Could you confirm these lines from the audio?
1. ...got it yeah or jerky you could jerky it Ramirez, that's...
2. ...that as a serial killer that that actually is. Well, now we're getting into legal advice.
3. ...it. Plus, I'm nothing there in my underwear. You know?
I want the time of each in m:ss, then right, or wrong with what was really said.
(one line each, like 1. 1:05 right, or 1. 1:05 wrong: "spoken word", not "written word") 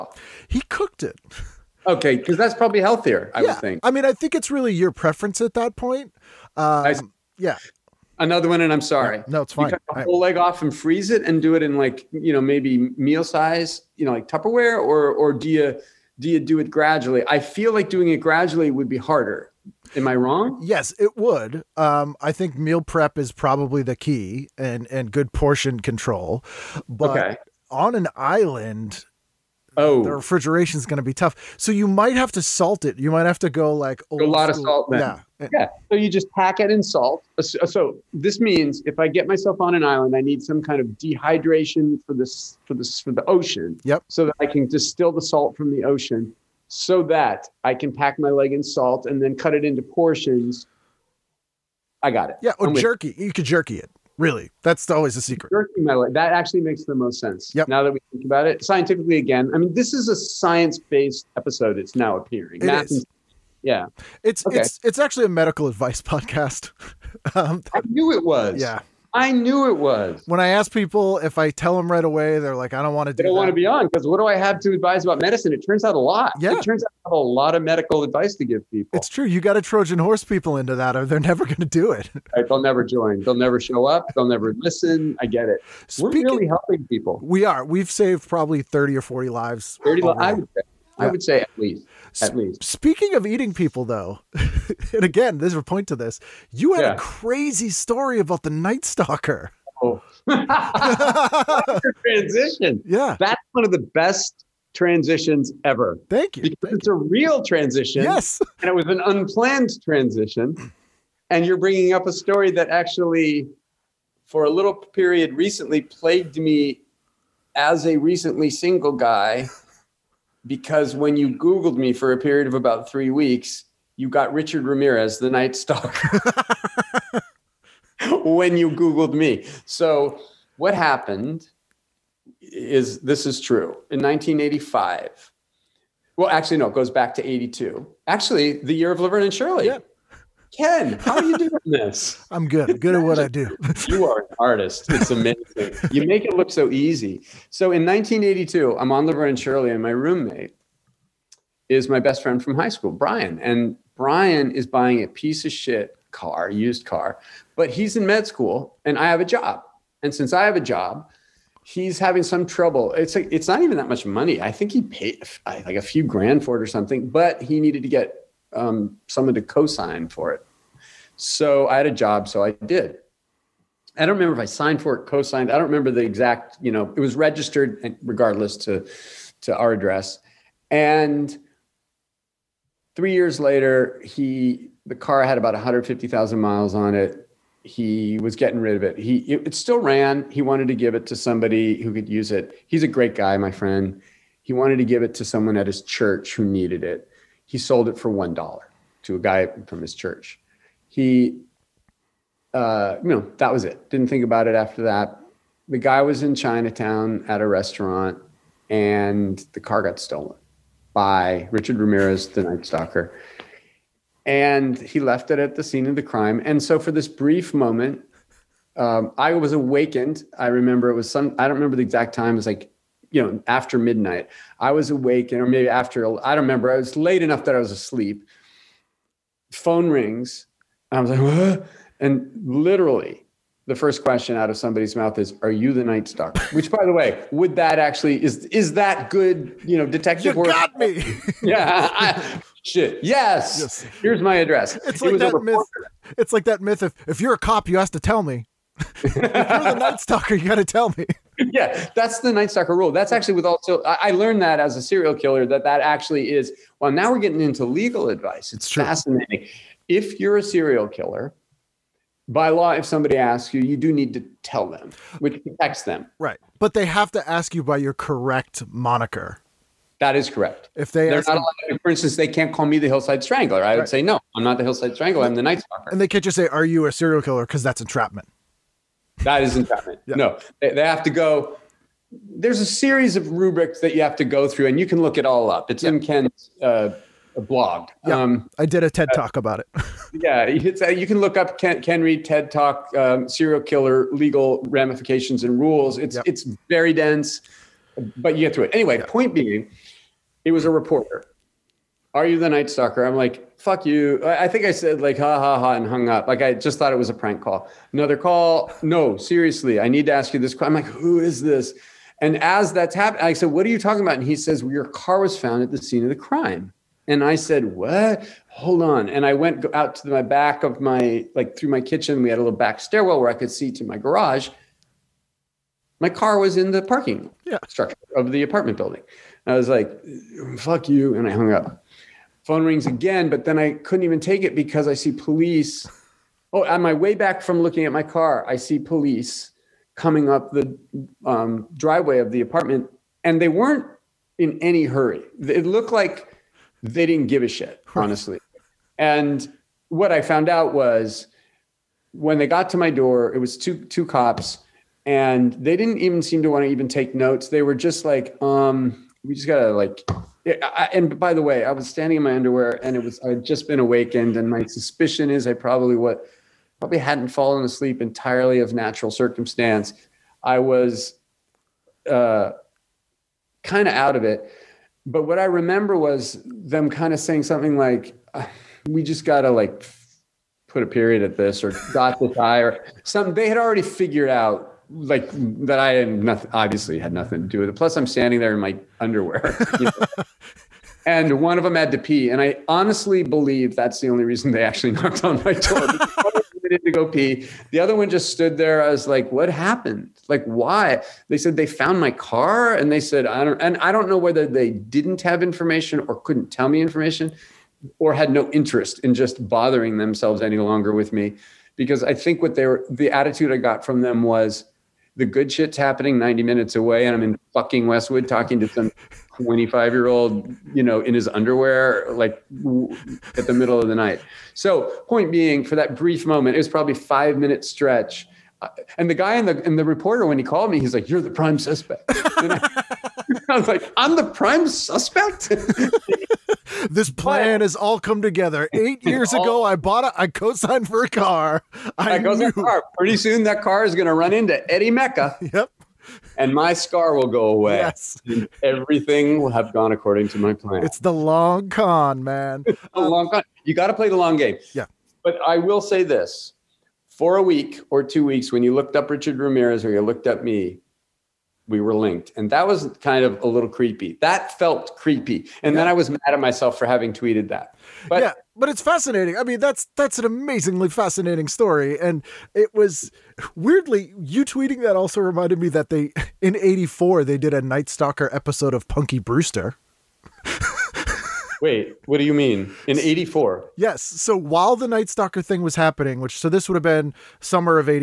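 1. 0:52 wrong: "Really", not "Ramirez"
2. 4:14 right
3. 6:27 wrong: "standing", not "nothing".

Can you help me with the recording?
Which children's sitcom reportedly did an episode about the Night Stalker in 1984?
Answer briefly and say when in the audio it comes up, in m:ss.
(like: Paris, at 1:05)
Punky Brewster, at 7:58.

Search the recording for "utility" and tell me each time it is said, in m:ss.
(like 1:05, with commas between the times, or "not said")
not said.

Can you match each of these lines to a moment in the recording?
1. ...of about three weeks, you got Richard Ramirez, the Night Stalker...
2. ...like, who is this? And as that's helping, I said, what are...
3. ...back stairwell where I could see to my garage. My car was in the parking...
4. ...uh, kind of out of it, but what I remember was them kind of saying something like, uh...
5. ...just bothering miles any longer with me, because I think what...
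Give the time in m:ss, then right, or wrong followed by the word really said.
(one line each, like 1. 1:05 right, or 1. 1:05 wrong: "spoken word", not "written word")
1. 2:02 right
2. 5:10 wrong: "happening", not "helping"
3. 5:22 right
4. 6:12 right
5. 6:49 wrong: "themselves", not "miles".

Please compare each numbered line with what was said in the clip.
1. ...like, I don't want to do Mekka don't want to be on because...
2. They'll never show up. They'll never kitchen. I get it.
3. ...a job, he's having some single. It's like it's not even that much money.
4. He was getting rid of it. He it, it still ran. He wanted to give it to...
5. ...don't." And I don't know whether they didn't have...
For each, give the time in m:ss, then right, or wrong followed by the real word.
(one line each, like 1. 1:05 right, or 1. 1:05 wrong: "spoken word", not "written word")
1. 1:12 wrong: "They", not "Mekka"
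2. 1:23 wrong: "listen", not "kitchen"
3. 2:40 wrong: "trouble", not "single"
4. 3:07 right
5. 6:43 right.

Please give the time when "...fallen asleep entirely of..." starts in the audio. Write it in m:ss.
6:07.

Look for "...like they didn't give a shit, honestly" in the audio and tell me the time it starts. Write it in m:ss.
5:45.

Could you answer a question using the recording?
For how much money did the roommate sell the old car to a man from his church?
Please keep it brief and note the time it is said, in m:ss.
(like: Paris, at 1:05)
$1, at 3:18.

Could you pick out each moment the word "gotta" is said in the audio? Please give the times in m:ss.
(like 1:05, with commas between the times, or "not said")
5:59, 6:19.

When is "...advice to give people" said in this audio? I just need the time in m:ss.
1:18.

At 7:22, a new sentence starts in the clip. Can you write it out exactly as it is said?
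Pretty soon, that car is going to run into Eddie Mekka.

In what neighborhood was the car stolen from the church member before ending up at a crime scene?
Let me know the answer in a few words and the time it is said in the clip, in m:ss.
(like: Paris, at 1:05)
Chinatown, at 3:26.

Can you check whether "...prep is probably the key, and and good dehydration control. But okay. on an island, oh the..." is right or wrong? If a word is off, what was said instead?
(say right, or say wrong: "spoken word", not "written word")
wrong: "portion", not "dehydration".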